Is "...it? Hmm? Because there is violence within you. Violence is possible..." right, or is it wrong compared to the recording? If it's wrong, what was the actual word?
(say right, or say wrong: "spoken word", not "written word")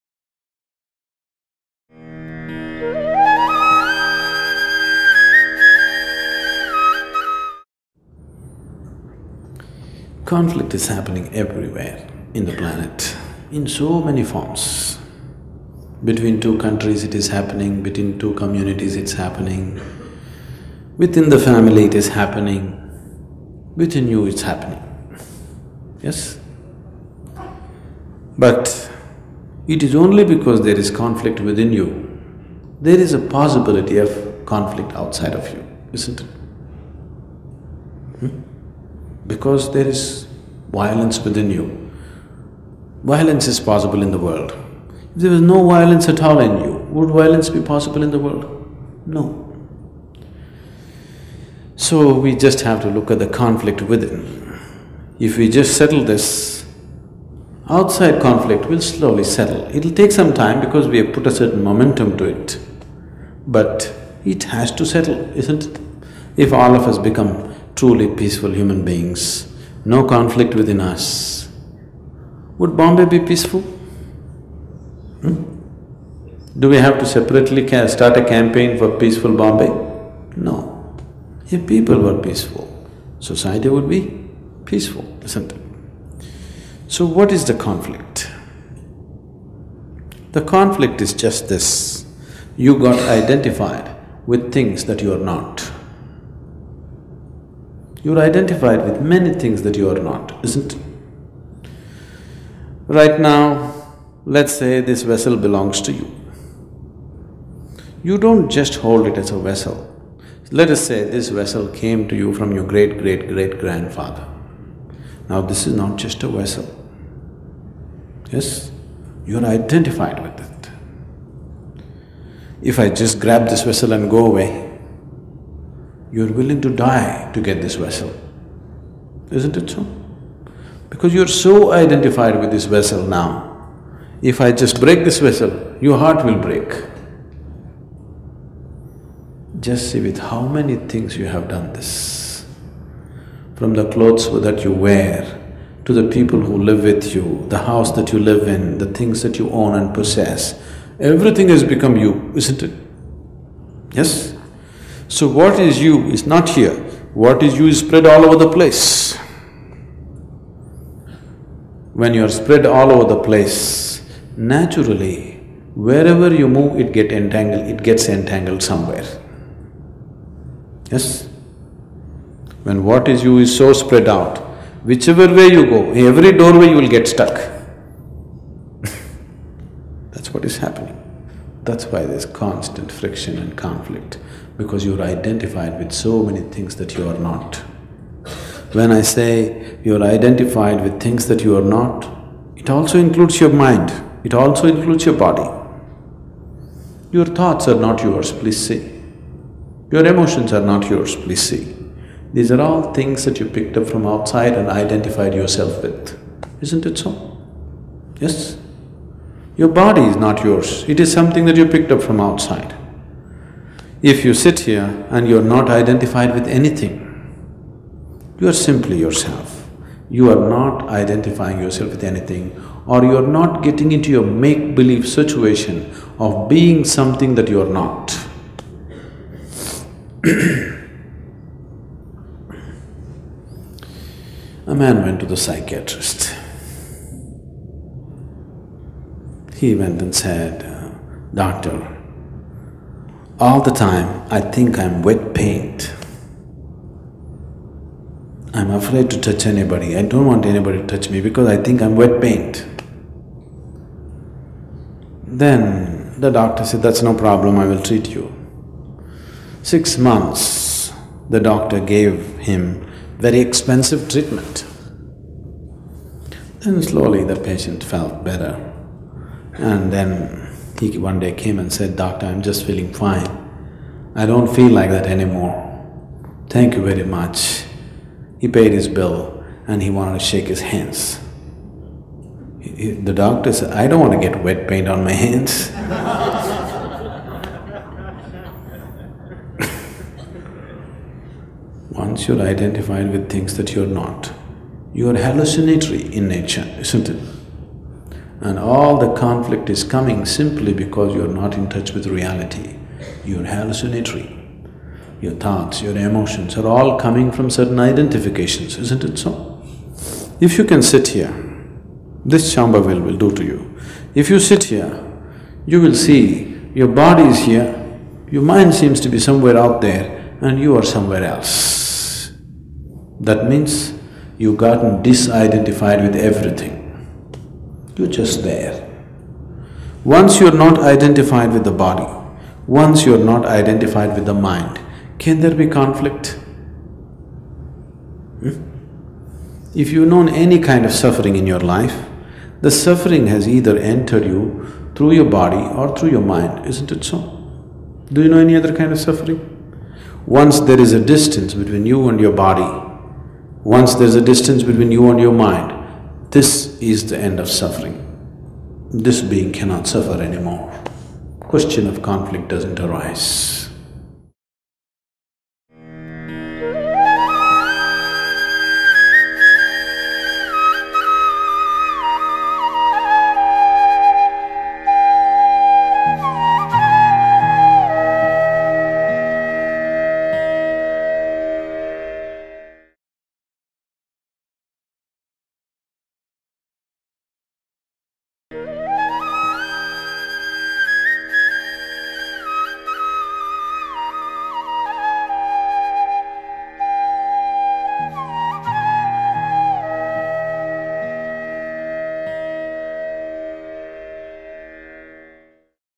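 right.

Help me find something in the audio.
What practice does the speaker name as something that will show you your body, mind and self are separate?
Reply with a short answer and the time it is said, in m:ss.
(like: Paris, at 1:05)
Shambhavi, at 5:12.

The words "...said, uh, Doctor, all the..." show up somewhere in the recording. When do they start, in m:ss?
4:00.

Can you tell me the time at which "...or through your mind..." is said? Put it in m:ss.
5:45.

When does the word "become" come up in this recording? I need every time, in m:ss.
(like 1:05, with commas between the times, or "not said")
1:06, 2:31.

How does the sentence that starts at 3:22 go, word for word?
These are all things that you picked up from outside and identified yourself with, isn't it so?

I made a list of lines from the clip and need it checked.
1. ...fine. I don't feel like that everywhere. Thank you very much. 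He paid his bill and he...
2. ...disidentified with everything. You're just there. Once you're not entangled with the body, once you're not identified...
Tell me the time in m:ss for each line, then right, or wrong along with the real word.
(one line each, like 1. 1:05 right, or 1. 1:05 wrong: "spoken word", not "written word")
1. 4:32 wrong: "anymore", not "everywhere"
2. 5:25 wrong: "identified", not "entangled".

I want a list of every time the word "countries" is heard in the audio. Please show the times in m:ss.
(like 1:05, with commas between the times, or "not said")
0:16.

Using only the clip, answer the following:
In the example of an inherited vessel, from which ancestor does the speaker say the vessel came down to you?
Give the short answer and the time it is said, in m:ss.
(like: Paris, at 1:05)
great great great grandfather, at 1:52.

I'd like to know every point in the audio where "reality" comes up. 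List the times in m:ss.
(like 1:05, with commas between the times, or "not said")
5:02.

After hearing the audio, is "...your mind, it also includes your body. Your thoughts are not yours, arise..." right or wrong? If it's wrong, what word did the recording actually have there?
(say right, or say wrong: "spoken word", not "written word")
wrong: "please", not "arise".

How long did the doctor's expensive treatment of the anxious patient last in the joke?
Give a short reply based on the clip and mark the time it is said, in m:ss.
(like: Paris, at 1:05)
6 months, at 4:19.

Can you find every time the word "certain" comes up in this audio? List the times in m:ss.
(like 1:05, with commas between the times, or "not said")
1:01, 5:07.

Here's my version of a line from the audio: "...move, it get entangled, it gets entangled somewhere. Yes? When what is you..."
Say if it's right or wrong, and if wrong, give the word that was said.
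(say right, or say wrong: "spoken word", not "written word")
right.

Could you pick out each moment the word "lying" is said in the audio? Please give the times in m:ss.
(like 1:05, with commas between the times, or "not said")
not said.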